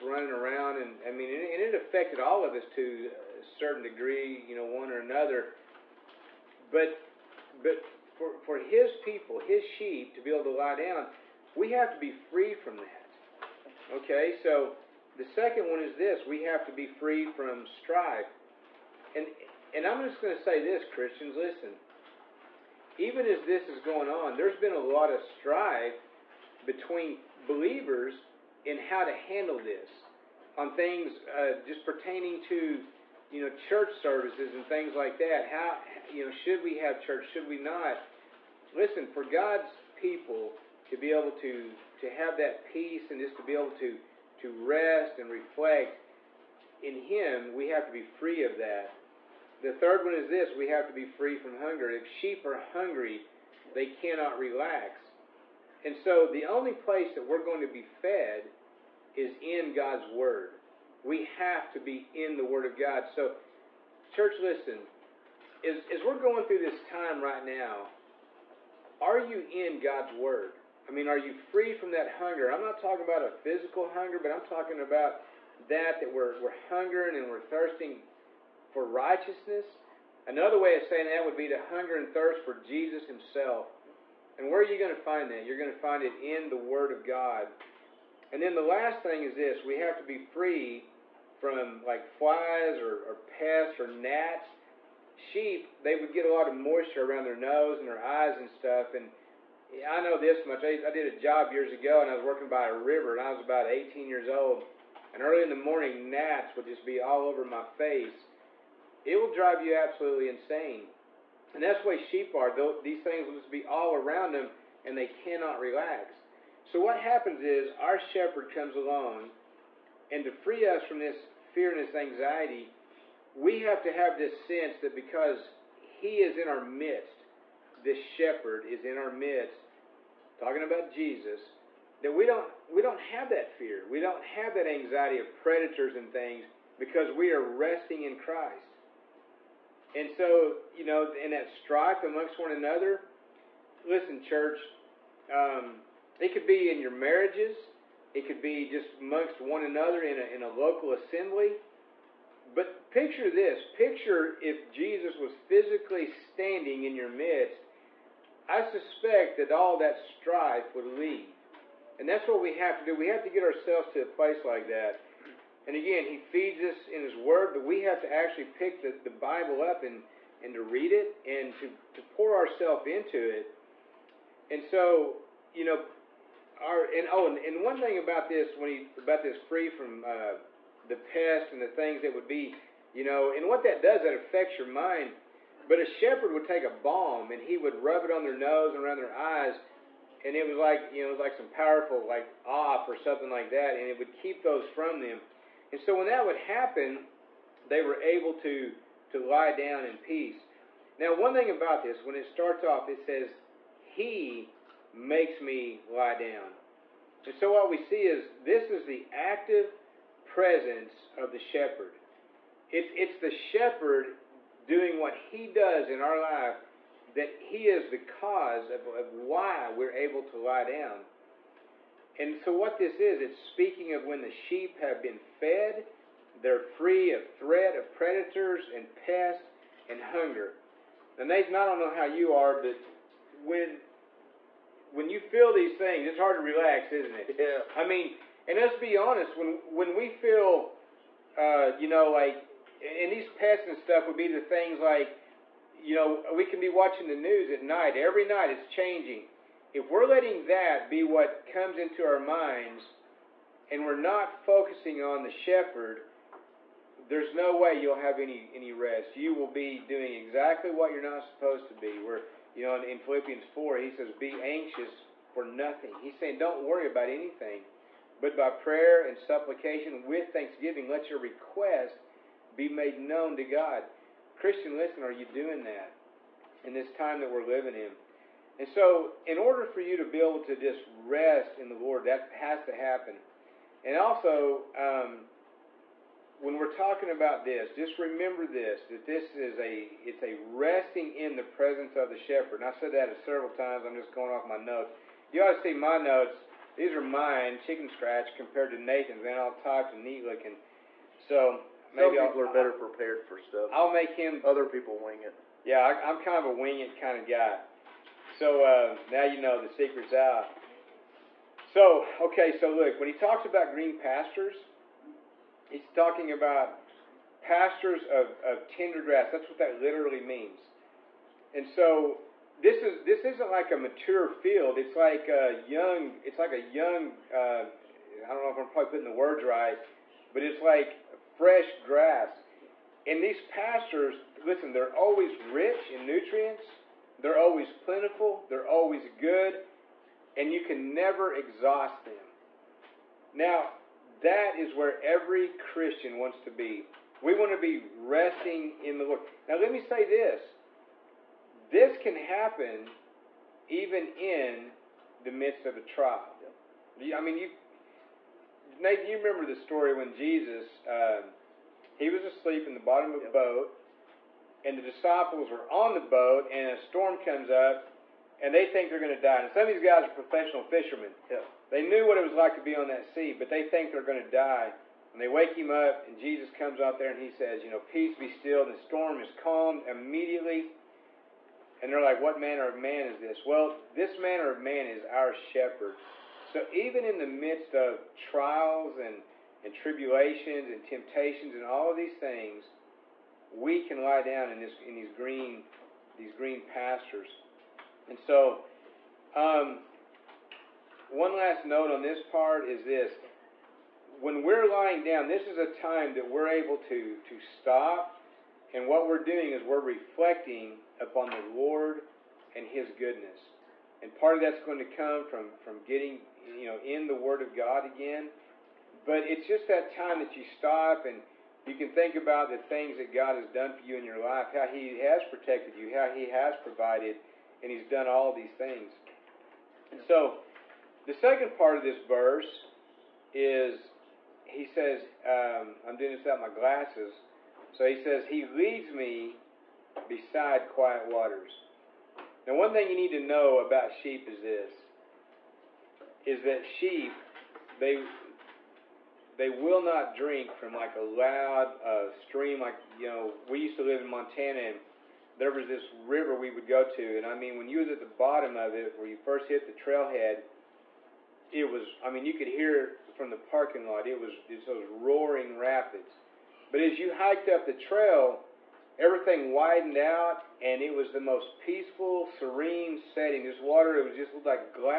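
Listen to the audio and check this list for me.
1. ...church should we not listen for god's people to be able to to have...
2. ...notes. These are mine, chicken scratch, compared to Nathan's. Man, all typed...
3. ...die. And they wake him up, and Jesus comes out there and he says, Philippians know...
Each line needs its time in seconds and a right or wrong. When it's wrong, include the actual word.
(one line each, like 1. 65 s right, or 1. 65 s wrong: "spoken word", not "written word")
1. 37 s right
2. 295 s right
3. 374 s wrong: "You", not "Philippians".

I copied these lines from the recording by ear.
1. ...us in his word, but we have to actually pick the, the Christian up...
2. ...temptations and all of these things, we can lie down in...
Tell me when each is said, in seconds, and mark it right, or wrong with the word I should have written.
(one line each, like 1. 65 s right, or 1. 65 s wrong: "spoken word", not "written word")
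1. 166 s wrong: "Bible", not "Christian"
2. 390 s right.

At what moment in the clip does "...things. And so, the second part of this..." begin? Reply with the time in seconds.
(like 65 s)
428 s.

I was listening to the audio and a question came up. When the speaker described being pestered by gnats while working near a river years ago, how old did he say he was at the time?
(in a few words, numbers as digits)
18.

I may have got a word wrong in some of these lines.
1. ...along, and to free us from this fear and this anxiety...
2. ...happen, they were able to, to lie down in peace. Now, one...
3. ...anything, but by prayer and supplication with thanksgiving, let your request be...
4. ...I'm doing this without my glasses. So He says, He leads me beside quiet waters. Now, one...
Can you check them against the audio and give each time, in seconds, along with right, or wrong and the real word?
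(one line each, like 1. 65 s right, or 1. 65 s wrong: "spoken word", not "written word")
1. 118 s right
2. 196 s right
3. 267 s right
4. 435 s right.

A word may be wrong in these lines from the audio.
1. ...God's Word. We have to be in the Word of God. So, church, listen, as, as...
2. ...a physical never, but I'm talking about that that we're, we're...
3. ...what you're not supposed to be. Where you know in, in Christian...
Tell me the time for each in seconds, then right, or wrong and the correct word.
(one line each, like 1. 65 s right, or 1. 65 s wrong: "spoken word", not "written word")
1. 59 s right
2. 73 s wrong: "hunger", not "never"
3. 260 s wrong: "Philippians", not "Christian".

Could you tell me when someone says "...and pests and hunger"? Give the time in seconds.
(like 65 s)
228 s.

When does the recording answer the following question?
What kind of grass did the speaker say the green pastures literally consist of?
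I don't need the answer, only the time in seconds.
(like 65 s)
318 s.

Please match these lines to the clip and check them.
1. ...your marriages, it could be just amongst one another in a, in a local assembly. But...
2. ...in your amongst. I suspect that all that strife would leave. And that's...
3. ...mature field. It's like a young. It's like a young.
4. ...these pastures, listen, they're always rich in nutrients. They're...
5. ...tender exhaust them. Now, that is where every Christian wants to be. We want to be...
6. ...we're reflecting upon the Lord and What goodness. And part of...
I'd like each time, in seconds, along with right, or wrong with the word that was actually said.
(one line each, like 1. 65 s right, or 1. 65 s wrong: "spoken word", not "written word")
1. 146 s right
2. 156 s wrong: "midst", not "amongst"
3. 323 s right
4. 333 s right
5. 340 s wrong: "never", not "tender"
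6. 409 s wrong: "His", not "What".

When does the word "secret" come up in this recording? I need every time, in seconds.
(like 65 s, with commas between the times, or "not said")
309 s.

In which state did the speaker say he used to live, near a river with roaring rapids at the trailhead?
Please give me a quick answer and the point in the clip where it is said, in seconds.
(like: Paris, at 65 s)
Montana, at 454 s.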